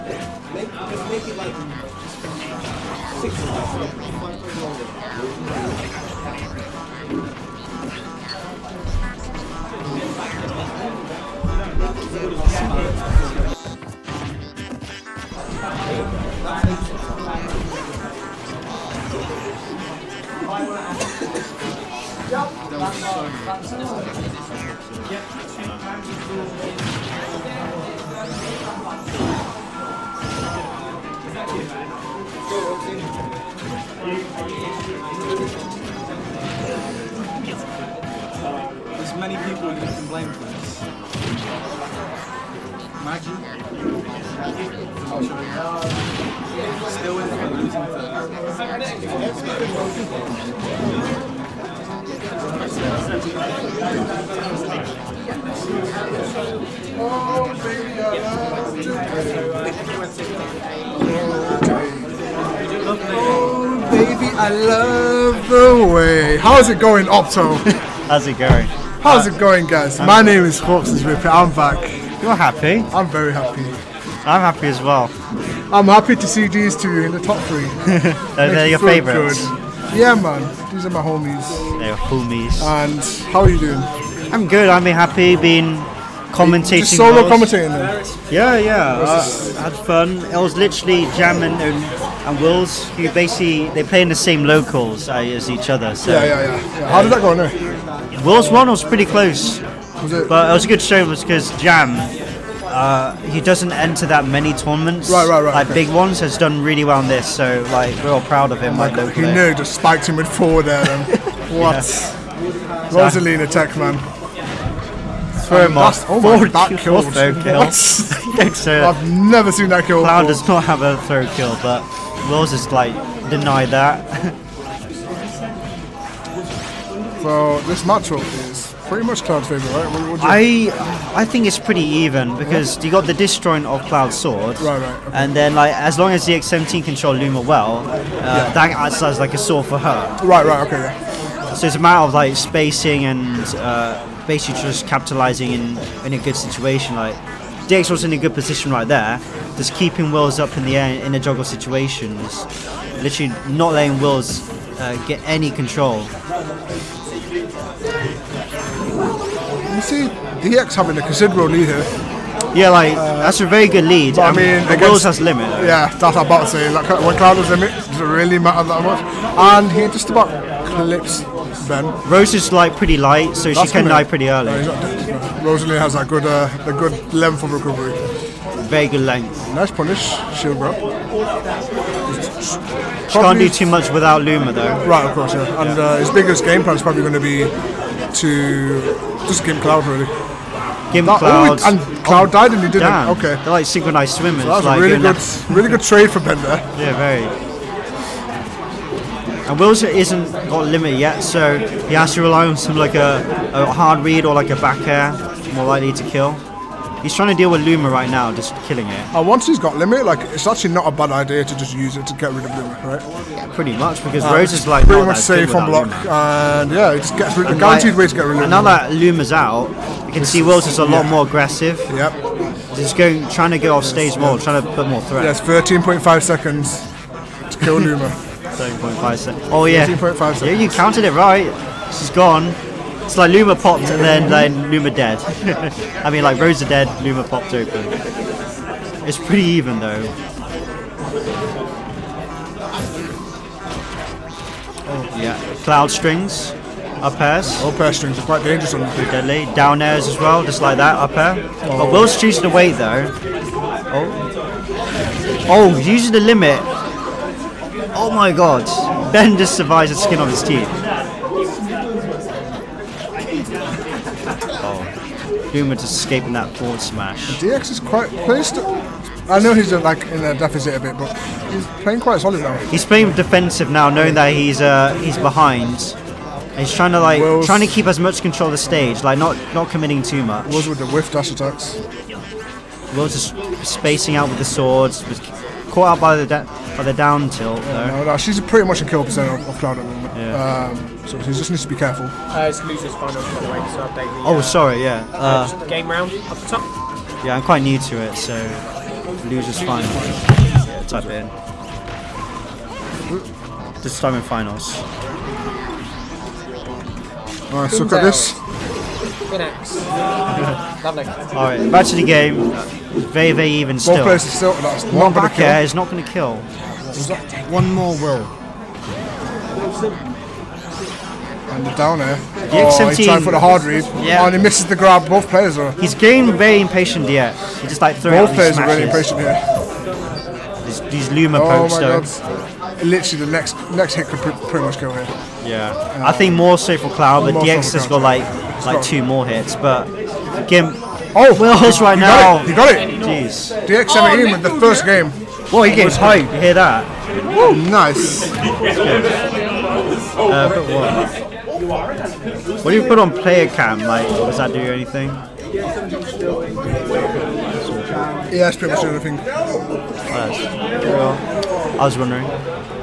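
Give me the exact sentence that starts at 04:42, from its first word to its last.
Willz just spacing out with the swords.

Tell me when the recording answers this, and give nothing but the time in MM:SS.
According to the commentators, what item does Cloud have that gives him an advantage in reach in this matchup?
02:13.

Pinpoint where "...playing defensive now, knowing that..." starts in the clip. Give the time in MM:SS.
04:32.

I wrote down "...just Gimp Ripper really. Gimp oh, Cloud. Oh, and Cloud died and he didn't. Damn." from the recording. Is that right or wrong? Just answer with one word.
wrong.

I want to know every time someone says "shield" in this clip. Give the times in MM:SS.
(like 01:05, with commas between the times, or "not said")
03:00.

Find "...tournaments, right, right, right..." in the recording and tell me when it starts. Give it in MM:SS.
01:44.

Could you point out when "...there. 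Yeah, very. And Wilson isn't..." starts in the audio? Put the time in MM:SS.
03:16.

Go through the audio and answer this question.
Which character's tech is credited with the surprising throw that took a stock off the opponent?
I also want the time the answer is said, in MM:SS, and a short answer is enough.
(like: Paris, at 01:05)
Rosalina, at 01:52.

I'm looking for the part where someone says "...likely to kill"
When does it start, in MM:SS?
03:25.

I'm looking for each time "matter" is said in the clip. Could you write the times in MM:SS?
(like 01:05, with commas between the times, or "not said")
02:21, 02:48.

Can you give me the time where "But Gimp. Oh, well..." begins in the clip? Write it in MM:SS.
05:39.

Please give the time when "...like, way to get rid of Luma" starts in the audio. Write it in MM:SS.
03:37.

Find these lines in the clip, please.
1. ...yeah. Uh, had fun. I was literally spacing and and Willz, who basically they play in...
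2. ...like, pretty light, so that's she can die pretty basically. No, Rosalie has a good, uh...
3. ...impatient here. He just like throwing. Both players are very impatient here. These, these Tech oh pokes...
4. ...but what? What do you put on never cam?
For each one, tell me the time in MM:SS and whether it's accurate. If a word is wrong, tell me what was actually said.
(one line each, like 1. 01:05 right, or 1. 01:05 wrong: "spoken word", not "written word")
1. 01:28 wrong: "jamming", not "spacing"
2. 02:52 wrong: "early", not "basically"
3. 05:26 wrong: "Luma", not "Tech"
4. 05:50 wrong: "player", not "never".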